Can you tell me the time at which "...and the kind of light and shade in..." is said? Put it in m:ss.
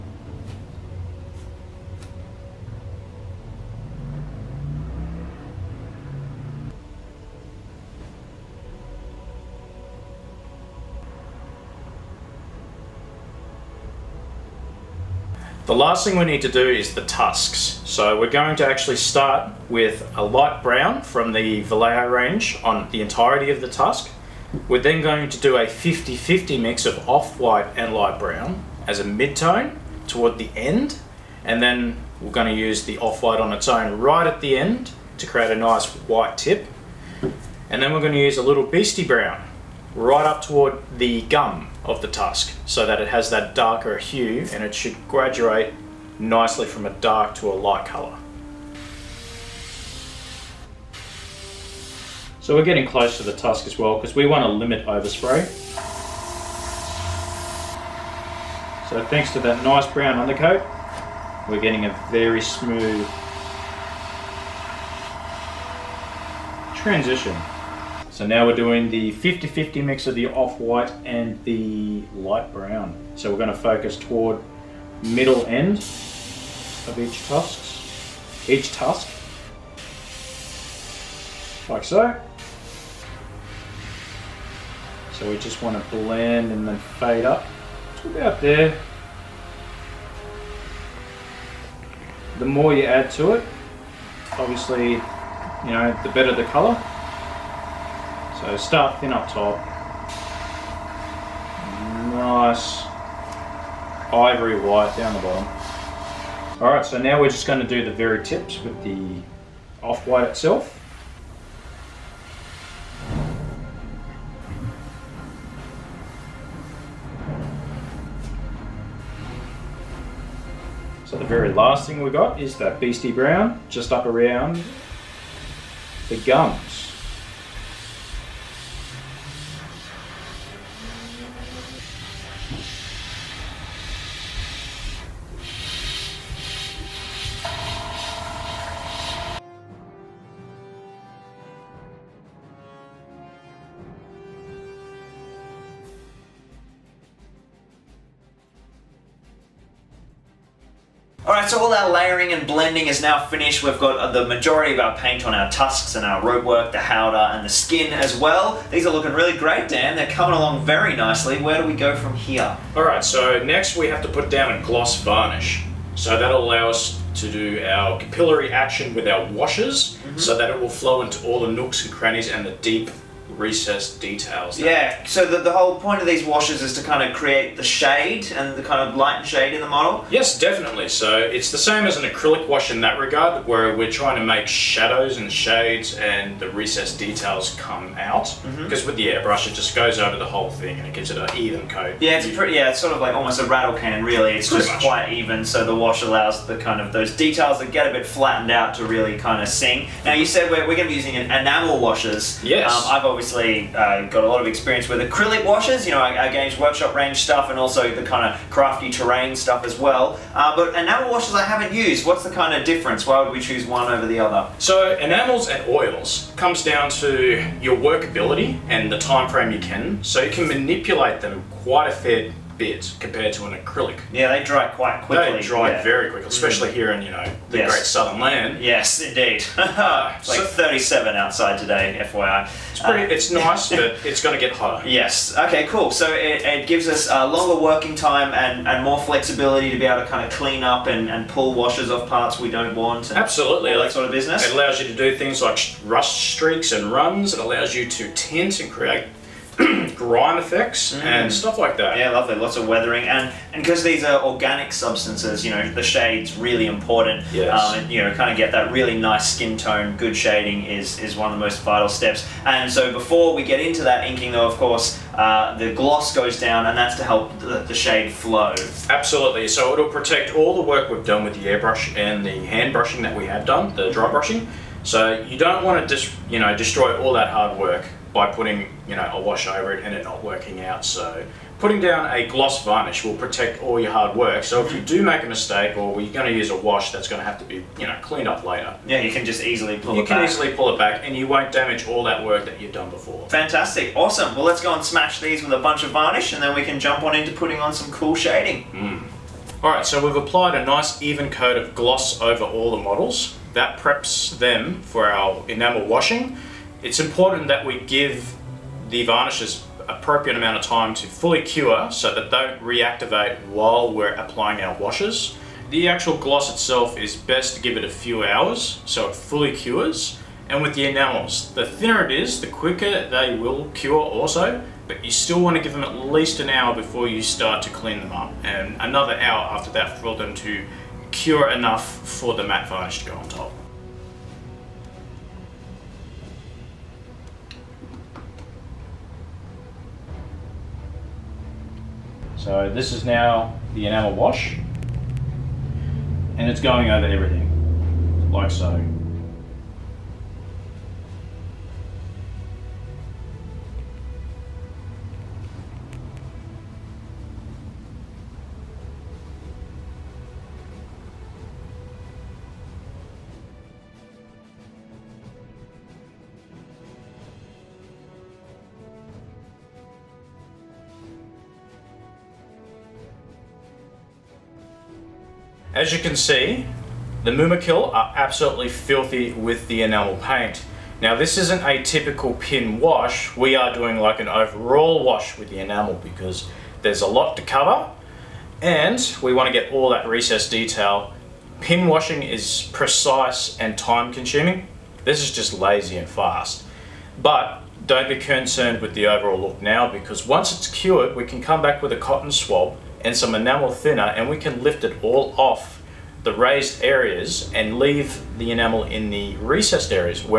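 2:58.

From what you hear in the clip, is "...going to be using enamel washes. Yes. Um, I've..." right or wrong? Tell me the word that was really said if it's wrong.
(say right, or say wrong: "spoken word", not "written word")
right.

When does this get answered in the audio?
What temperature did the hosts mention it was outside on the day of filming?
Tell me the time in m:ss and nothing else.
3:50.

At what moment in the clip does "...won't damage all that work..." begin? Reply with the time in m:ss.
4:51.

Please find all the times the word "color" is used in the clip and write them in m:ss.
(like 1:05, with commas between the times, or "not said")
0:47, 1:36.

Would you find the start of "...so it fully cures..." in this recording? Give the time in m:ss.
5:18.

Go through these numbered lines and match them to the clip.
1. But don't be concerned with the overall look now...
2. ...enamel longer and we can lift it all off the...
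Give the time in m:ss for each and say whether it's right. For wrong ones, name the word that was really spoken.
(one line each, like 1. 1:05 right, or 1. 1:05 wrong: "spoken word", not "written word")
1. 6:37 right
2. 6:43 wrong: "thinner", not "longer".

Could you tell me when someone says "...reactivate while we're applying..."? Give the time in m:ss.
5:12.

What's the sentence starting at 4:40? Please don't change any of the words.
So putting down a gloss varnish will protect all your hard work.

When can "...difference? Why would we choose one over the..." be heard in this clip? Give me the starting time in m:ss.
3:32.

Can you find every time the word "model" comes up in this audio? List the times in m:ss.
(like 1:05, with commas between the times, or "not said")
2:59, 5:02.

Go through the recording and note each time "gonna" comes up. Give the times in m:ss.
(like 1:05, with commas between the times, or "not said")
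1:13, 1:47.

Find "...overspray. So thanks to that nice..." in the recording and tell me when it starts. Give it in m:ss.
0:54.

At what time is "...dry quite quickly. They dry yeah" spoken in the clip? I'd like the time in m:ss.
3:44.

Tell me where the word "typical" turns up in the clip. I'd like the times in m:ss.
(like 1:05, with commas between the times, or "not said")
6:21.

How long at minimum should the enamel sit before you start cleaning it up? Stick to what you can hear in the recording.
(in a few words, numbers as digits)
an hour.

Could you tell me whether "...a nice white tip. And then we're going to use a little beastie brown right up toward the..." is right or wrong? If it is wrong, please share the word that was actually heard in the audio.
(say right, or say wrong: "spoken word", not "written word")
right.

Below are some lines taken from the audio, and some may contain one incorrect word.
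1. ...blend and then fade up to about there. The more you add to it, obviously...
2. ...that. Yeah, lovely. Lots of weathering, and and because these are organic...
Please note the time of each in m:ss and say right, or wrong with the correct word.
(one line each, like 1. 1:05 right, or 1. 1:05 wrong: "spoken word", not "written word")
1. 1:25 right
2. 4:11 right.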